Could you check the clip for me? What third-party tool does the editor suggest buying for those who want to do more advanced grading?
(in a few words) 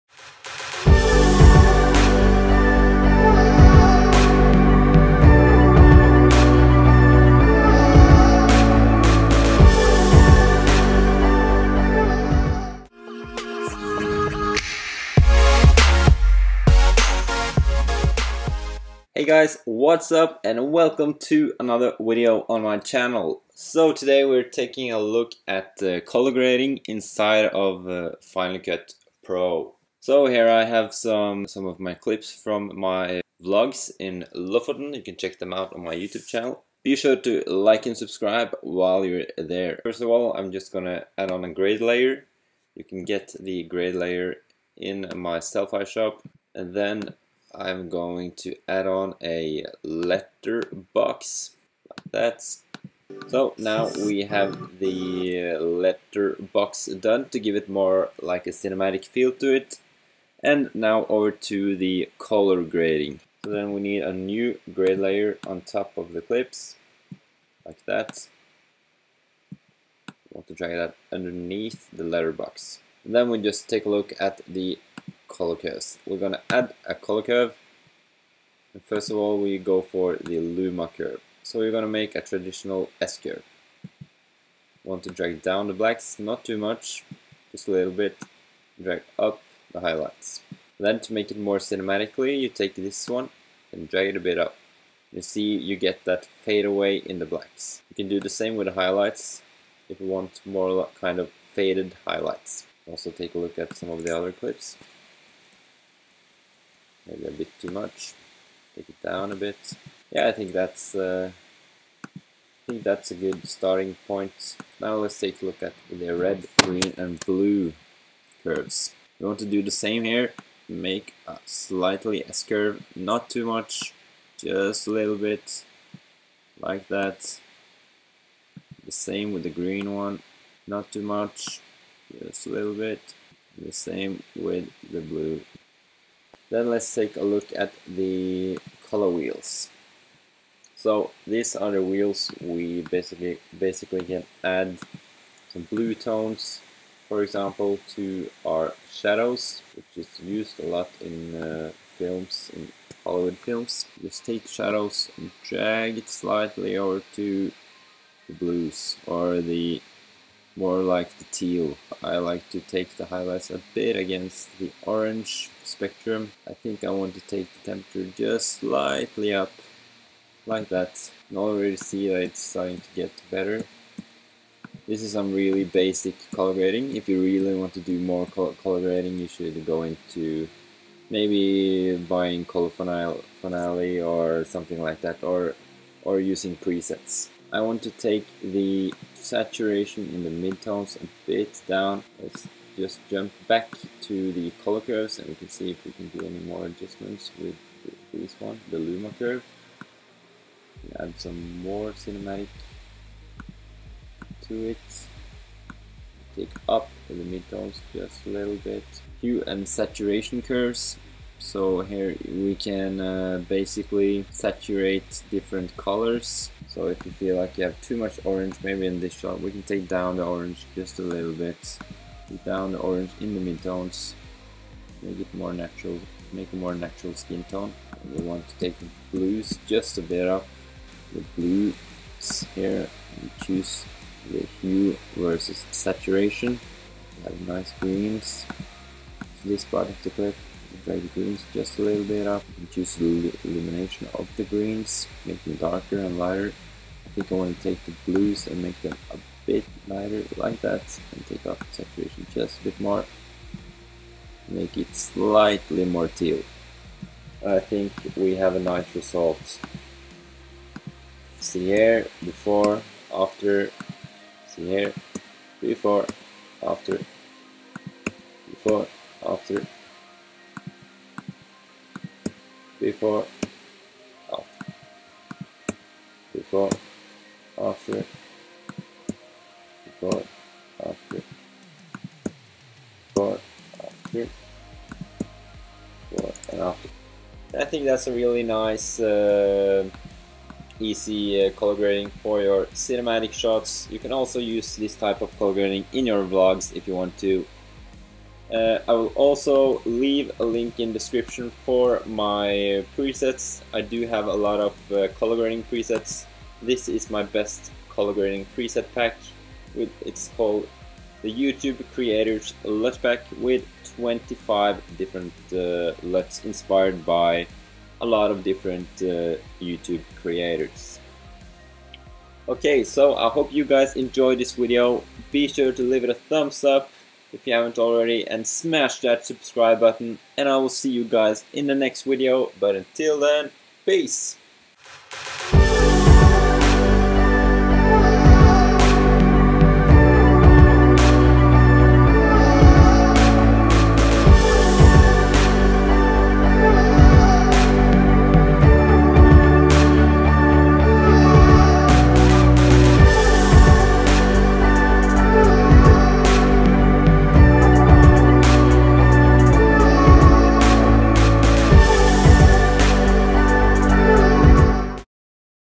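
Color Finale.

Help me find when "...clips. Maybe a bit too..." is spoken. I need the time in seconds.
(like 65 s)
104 s.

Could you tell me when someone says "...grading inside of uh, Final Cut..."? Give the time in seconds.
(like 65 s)
26 s.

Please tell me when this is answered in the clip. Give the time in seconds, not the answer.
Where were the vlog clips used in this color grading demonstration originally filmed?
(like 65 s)
34 s.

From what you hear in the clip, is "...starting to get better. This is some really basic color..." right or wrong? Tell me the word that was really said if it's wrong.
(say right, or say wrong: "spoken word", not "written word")
right.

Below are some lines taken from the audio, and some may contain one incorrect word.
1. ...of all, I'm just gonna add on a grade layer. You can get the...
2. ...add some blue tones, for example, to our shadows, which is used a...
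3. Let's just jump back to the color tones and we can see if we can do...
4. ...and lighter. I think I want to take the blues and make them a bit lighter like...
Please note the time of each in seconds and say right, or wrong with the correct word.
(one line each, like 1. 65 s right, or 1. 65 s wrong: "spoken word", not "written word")
1. 40 s right
2. 144 s right
3. 192 s wrong: "curves", not "tones"
4. 245 s right.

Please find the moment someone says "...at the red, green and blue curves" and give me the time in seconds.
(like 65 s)
115 s.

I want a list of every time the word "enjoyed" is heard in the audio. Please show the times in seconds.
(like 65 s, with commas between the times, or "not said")
323 s.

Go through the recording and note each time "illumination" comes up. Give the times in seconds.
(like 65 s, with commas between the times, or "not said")
243 s.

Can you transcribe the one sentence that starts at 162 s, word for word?
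I like to take the highlights a bit against the orange spectrum.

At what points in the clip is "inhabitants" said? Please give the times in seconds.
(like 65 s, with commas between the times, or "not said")
not said.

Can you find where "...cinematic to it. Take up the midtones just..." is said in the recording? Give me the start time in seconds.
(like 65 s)
201 s.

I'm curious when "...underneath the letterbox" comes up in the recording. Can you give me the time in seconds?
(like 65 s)
71 s.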